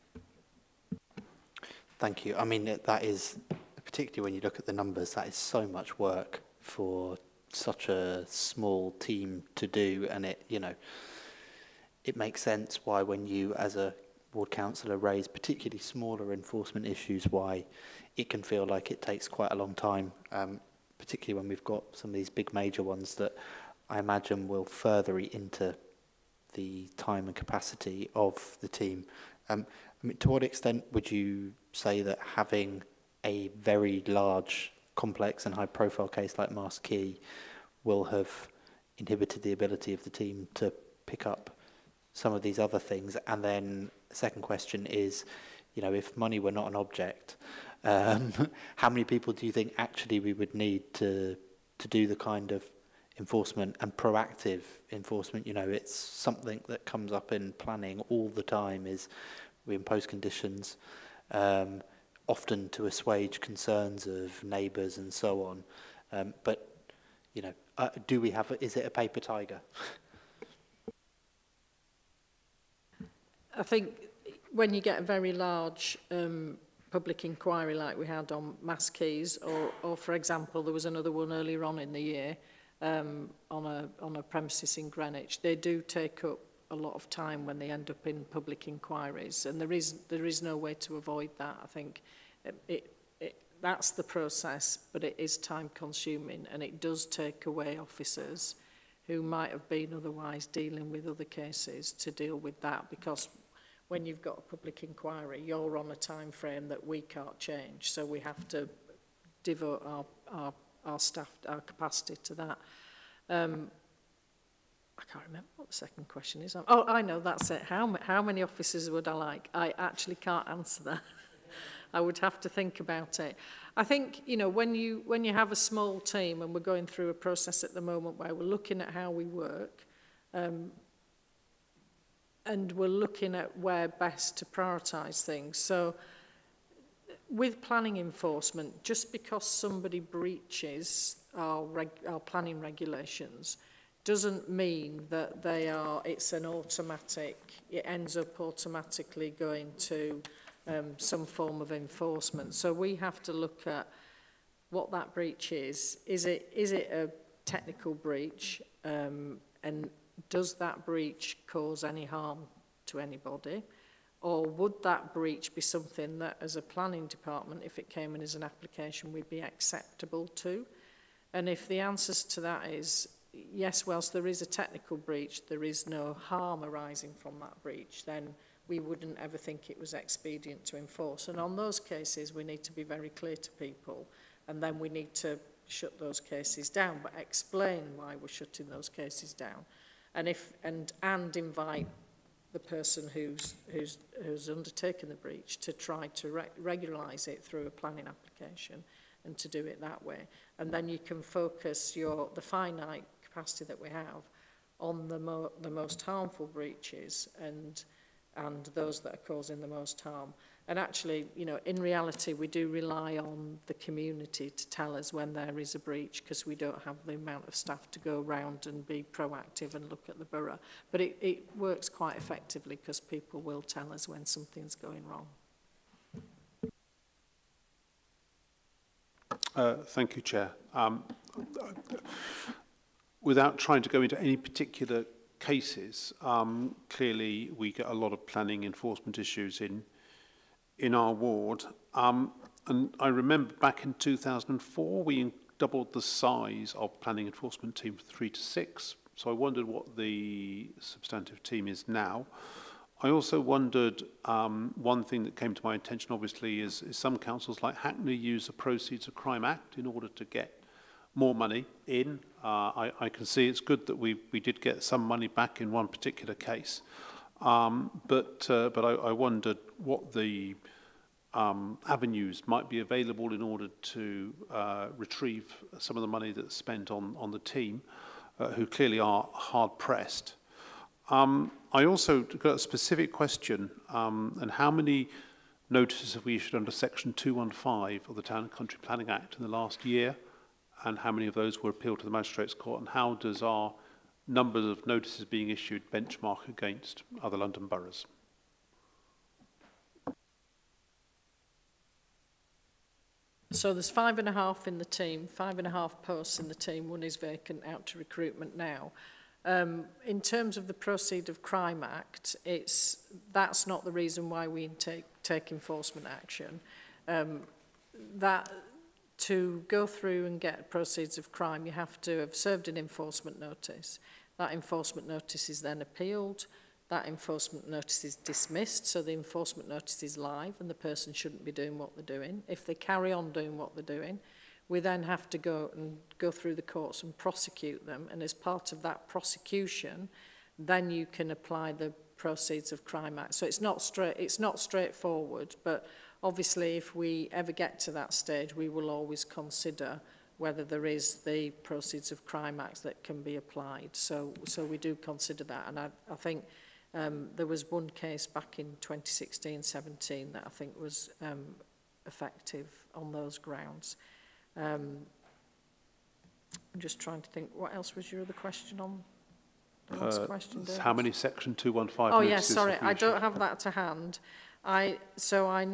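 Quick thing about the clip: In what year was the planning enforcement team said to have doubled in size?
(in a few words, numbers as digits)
2004.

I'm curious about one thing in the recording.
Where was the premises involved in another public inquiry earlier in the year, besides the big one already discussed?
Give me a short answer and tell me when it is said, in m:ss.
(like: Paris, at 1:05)
Greenwich, at 1:24.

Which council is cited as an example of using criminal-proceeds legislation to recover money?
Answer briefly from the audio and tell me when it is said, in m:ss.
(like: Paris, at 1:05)
Hackney, at 4:17.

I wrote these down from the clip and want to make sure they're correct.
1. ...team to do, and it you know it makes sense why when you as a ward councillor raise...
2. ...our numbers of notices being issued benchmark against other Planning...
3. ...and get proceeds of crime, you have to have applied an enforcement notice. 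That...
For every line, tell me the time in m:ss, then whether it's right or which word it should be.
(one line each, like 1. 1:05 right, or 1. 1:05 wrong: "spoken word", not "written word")
1. 0:08 right
2. 4:53 wrong: "London", not "Planning"
3. 5:20 wrong: "served", not "applied".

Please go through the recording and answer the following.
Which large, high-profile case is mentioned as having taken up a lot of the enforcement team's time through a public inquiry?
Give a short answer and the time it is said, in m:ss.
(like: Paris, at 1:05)
Mast Quay, at 0:36.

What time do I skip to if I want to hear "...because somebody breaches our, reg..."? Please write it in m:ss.
2:19.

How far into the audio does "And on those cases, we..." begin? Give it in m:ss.
3:01.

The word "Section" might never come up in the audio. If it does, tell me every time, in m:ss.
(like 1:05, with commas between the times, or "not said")
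4:46, 6:11.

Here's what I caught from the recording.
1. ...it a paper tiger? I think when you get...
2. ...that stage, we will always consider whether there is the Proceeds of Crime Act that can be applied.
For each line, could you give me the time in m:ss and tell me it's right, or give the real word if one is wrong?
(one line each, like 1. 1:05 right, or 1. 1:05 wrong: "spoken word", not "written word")
1. 1:08 right
2. 5:47 right.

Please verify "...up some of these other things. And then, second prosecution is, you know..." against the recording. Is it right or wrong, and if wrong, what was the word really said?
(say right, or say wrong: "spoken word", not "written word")
wrong: "question", not "prosecution".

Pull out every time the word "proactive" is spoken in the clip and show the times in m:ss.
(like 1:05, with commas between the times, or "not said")
0:53, 3:39.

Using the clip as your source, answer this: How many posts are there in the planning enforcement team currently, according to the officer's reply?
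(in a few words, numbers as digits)
5 and a half.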